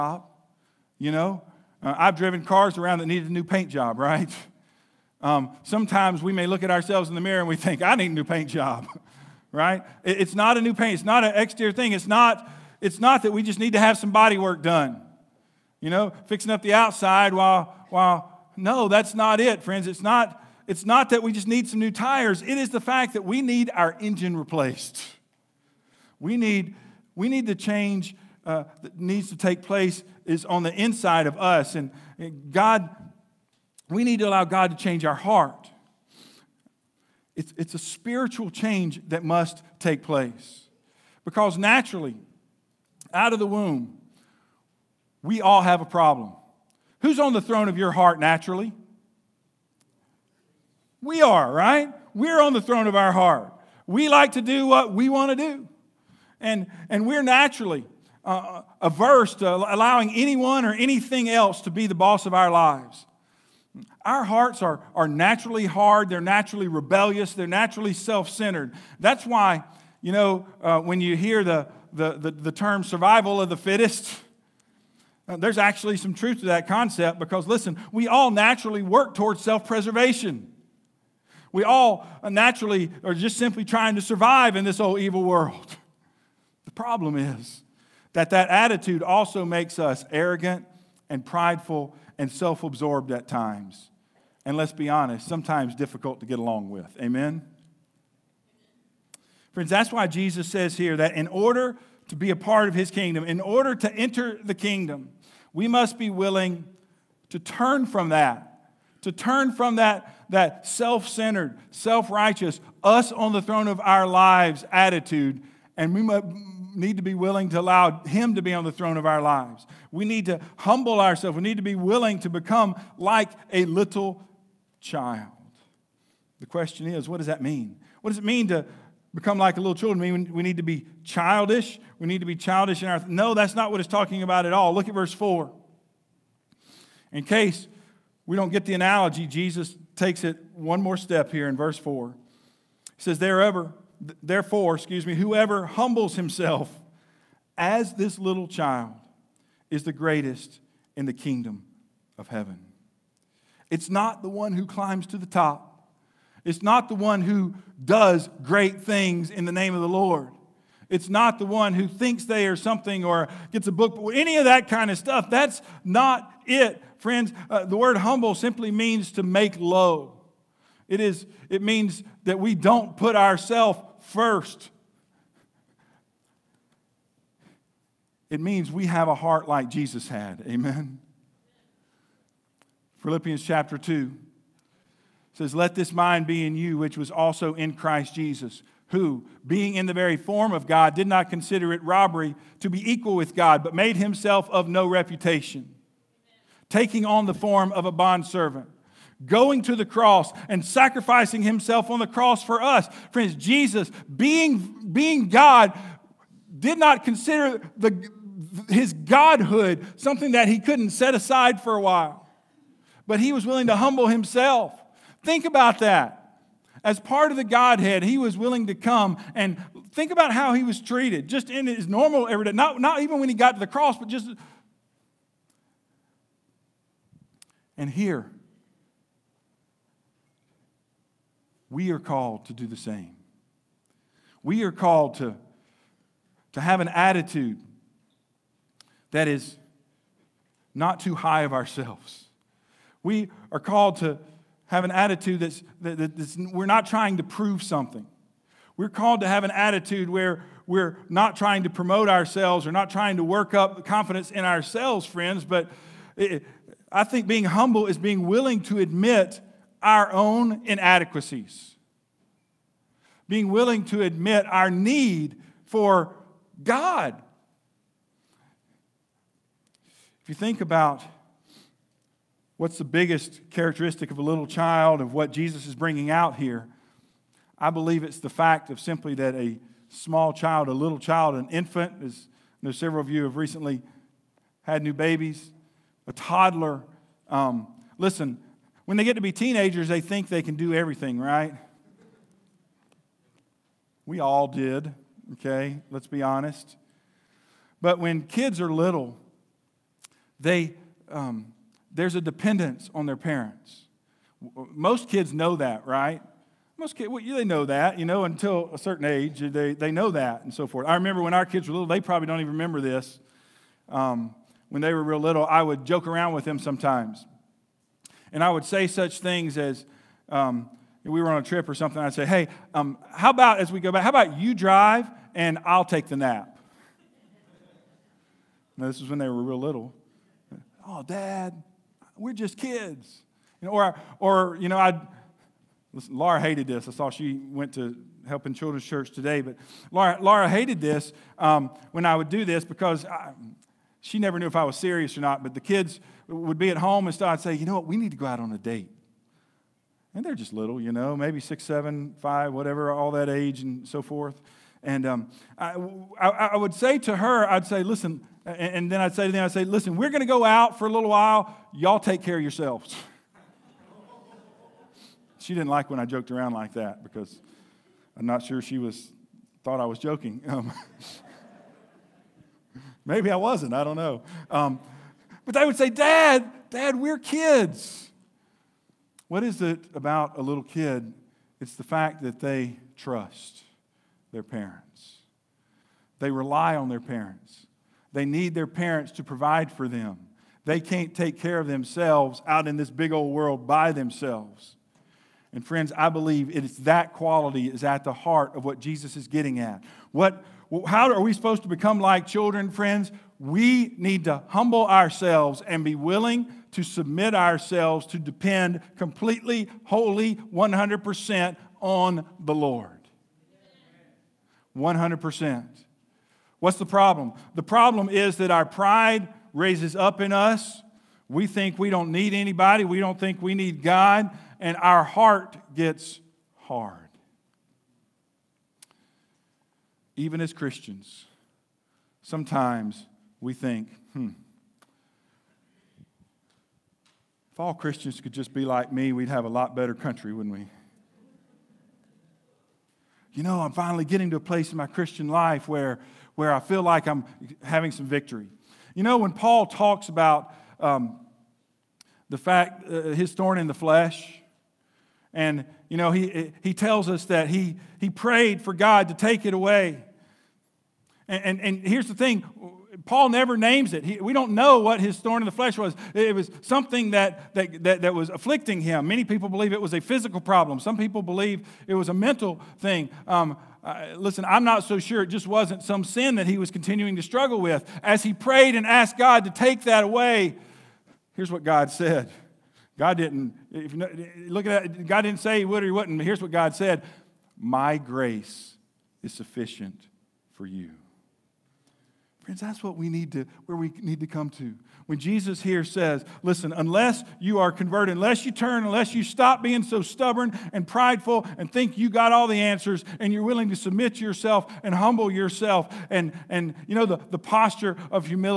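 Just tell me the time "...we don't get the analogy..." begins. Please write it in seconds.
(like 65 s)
138 s.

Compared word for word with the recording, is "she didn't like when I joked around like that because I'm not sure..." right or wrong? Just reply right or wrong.
right.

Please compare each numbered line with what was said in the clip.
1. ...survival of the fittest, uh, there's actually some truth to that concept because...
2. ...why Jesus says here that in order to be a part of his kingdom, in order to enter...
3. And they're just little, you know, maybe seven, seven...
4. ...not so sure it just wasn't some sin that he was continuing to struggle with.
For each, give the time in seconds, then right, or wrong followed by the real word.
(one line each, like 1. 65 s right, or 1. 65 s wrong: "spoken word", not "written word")
1. 72 s right
2. 99 s right
3. 350 s wrong: "six", not "seven"
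4. 474 s right.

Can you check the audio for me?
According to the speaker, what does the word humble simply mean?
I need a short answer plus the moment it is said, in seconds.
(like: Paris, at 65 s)
to make low, at 169 s.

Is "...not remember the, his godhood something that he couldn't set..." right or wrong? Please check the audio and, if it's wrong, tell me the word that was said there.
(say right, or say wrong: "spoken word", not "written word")
wrong: "consider", not "remember".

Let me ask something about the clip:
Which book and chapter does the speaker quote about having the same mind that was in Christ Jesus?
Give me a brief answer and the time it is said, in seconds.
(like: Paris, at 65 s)
Philippians 2, at 182 s.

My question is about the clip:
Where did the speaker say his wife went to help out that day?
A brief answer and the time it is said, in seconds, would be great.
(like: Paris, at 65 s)
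children's church, at 338 s.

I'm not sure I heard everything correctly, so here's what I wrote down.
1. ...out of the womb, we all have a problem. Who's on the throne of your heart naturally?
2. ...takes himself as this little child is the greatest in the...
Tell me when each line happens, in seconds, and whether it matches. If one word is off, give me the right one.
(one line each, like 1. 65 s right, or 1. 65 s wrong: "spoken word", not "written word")
1. 43 s right
2. 145 s wrong: "humbles", not "takes".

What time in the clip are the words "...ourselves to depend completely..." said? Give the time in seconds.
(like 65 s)
407 s.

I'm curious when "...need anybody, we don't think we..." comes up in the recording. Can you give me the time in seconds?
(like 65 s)
422 s.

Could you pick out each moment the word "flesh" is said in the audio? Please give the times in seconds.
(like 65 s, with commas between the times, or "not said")
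453 s, 465 s.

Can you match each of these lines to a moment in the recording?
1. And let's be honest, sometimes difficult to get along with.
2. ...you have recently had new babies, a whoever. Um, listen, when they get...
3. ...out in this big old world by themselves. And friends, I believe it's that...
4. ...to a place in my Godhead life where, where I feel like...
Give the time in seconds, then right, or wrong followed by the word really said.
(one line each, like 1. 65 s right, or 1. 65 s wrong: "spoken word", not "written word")
1. 94 s right
2. 283 s wrong: "toddler", not "whoever"
3. 392 s right
4. 444 s wrong: "Christian", not "Godhead".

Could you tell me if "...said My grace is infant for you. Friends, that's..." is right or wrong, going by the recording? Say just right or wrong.
wrong.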